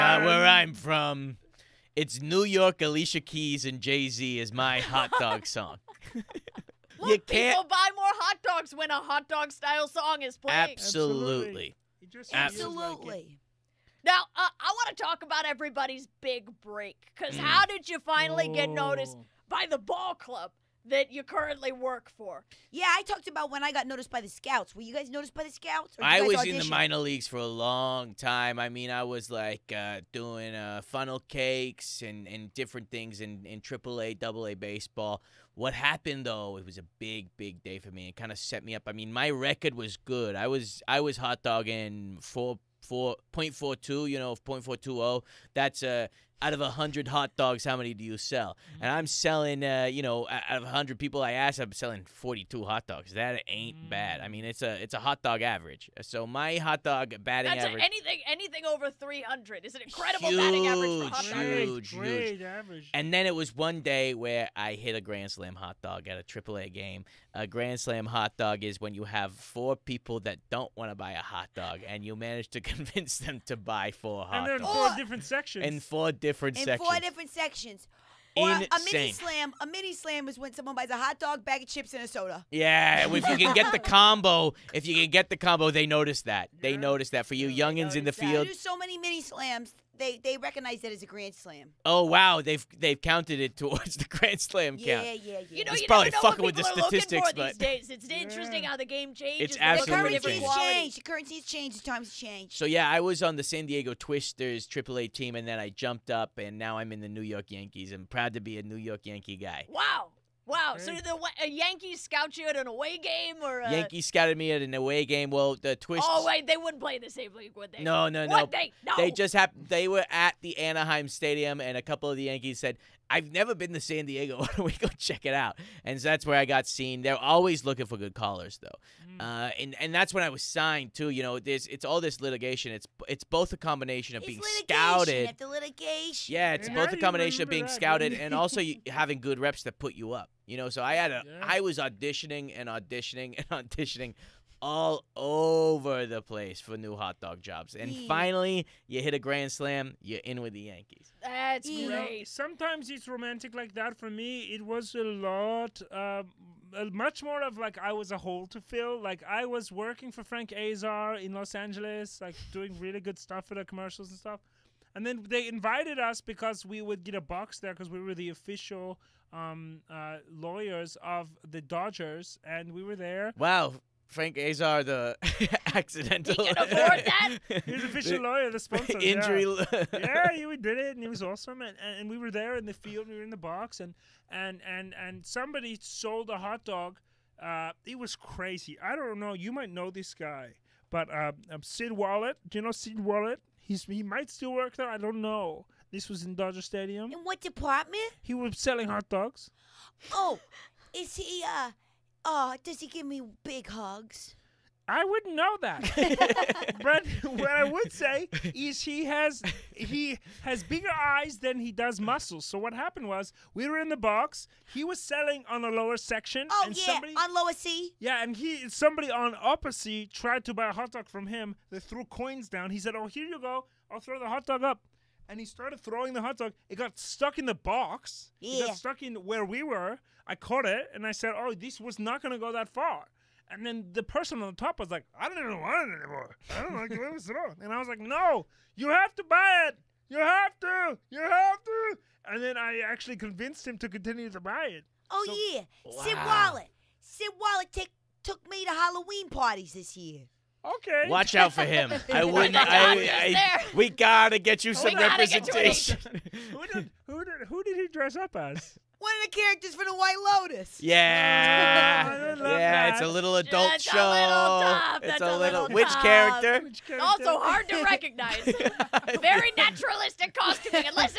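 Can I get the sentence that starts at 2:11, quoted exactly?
You know, there's it's all this litigation.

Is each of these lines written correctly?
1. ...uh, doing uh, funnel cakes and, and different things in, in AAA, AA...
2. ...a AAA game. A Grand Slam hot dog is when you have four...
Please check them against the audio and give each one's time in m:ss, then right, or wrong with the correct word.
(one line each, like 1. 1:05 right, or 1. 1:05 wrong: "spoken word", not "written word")
1. 0:29 right
2. 1:06 right.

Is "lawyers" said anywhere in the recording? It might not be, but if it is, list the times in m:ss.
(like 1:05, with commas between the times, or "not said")
2:50, 2:58.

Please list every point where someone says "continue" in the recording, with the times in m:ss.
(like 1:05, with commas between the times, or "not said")
4:03.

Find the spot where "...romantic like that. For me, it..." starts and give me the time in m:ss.
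2:33.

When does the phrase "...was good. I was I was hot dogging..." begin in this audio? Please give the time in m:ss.
0:39.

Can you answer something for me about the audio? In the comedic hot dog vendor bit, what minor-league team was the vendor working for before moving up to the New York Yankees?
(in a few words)
San Diego Twisters.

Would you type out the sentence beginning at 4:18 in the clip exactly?
One of the characters from the White Lotus.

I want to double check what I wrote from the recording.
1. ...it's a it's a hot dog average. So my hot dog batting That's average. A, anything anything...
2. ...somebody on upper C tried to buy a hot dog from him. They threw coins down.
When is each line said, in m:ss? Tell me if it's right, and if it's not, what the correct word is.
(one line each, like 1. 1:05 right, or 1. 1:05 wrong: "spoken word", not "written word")
1. 0:54 right
2. 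3:38 right.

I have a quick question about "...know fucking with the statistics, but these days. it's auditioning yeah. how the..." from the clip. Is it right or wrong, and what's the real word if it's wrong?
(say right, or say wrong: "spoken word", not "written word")
wrong: "interesting", not "auditioning".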